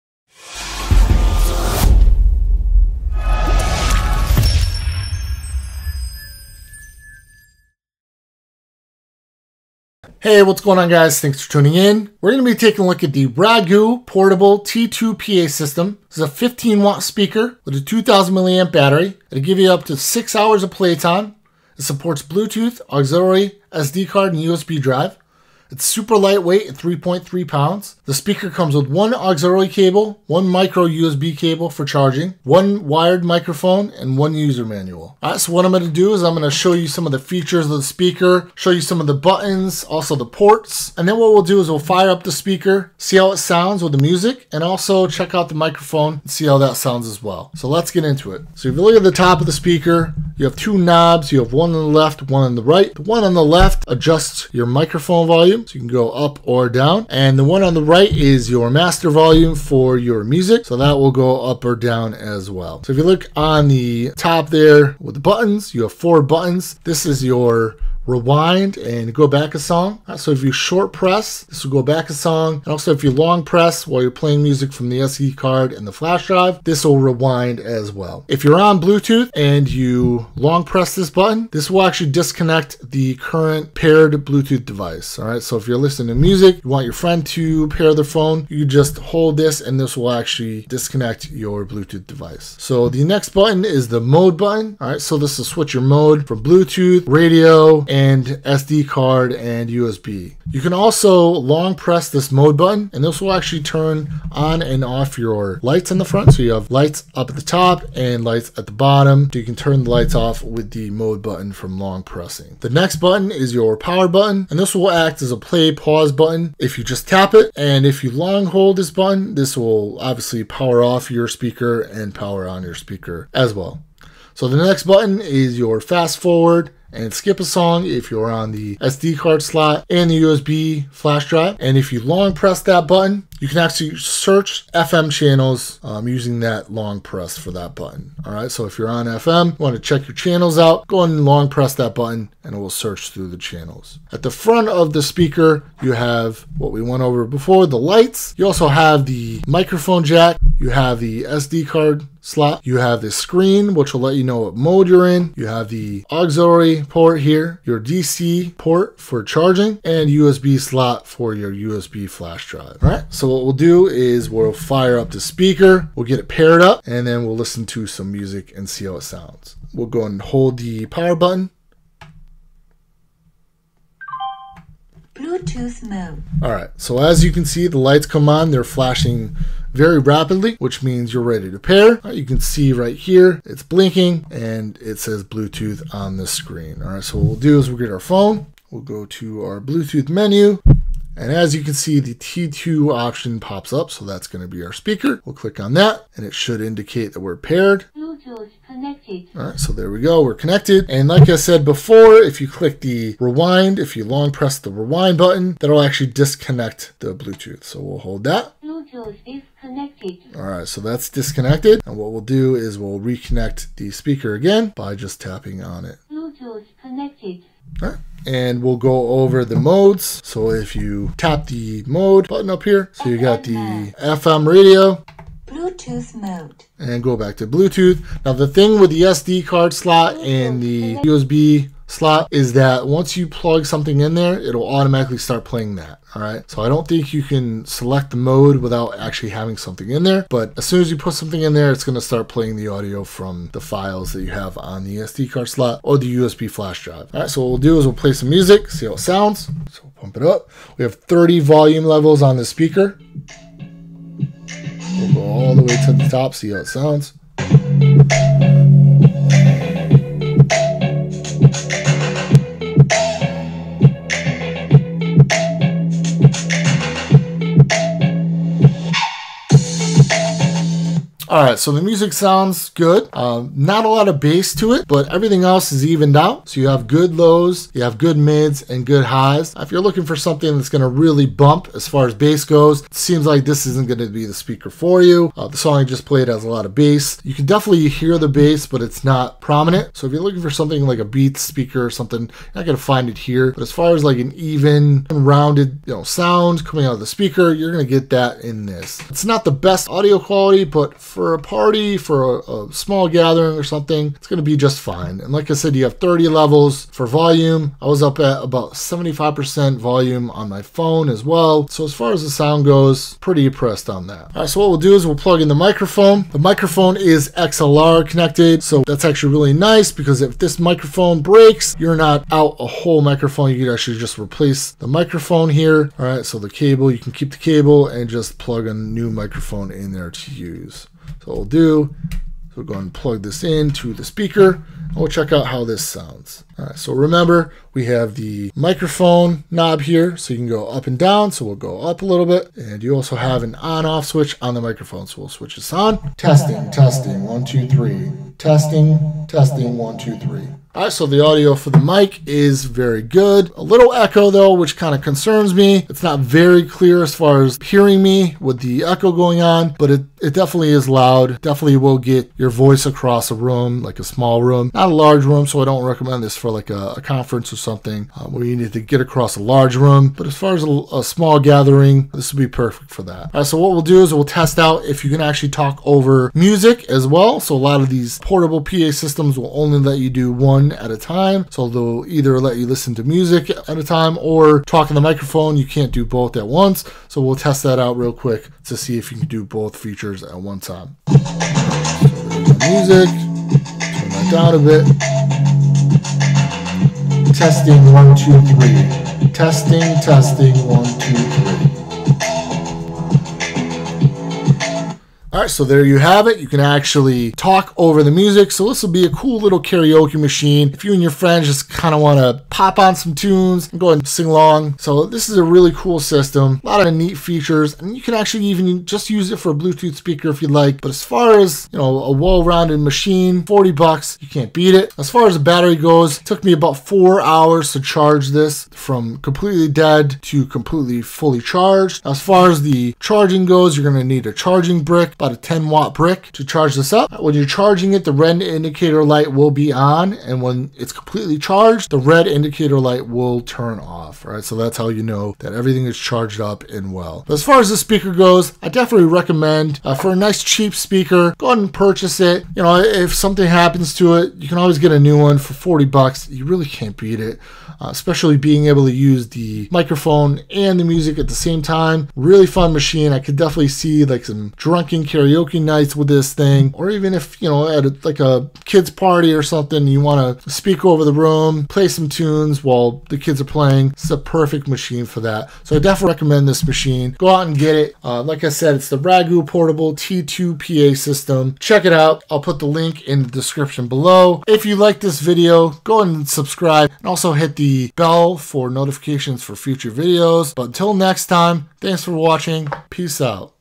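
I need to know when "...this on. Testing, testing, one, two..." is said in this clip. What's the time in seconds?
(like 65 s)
345 s.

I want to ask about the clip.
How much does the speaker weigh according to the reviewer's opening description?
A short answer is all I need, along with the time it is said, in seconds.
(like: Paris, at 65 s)
3.3 pounds, at 26 s.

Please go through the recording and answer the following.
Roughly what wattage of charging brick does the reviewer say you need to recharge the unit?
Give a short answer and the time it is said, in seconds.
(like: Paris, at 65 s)
10 watt, at 435 s.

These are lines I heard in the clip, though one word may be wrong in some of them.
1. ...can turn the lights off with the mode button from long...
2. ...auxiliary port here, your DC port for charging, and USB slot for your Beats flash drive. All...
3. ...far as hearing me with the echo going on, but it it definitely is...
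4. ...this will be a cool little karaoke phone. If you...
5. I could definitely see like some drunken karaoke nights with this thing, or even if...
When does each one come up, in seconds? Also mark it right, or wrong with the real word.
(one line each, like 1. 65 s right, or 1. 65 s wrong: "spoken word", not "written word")
1. 109 s right
2. 156 s wrong: "USB", not "Beats"
3. 357 s right
4. 408 s wrong: "machine", not "phone"
5. 463 s right.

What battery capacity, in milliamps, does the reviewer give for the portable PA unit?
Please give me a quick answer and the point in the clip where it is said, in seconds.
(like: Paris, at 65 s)
2000, at 17 s.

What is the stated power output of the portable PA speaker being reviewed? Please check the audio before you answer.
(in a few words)
15 watts.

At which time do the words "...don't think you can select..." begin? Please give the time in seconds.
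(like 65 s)
236 s.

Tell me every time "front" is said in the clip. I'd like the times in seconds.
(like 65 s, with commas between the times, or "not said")
106 s, 144 s.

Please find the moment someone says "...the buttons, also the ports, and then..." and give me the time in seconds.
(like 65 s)
39 s.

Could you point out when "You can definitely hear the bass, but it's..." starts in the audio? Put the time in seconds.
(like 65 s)
287 s.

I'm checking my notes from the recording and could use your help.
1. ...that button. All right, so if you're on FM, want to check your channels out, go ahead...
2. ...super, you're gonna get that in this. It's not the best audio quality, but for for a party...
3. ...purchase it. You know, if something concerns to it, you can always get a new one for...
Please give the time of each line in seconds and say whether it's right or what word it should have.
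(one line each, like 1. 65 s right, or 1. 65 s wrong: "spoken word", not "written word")
1. 137 s right
2. 297 s wrong: "speaker", not "super"
3. 451 s wrong: "happens", not "concerns".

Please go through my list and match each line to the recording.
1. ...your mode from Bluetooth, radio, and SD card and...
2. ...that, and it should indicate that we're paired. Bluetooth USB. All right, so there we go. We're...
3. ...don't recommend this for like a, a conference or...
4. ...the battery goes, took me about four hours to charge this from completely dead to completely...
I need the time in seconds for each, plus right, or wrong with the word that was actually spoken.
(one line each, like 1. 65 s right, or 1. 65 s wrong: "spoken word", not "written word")
1. 95 s right
2. 195 s wrong: "Connected", not "USB"
3. 365 s right
4. 425 s right.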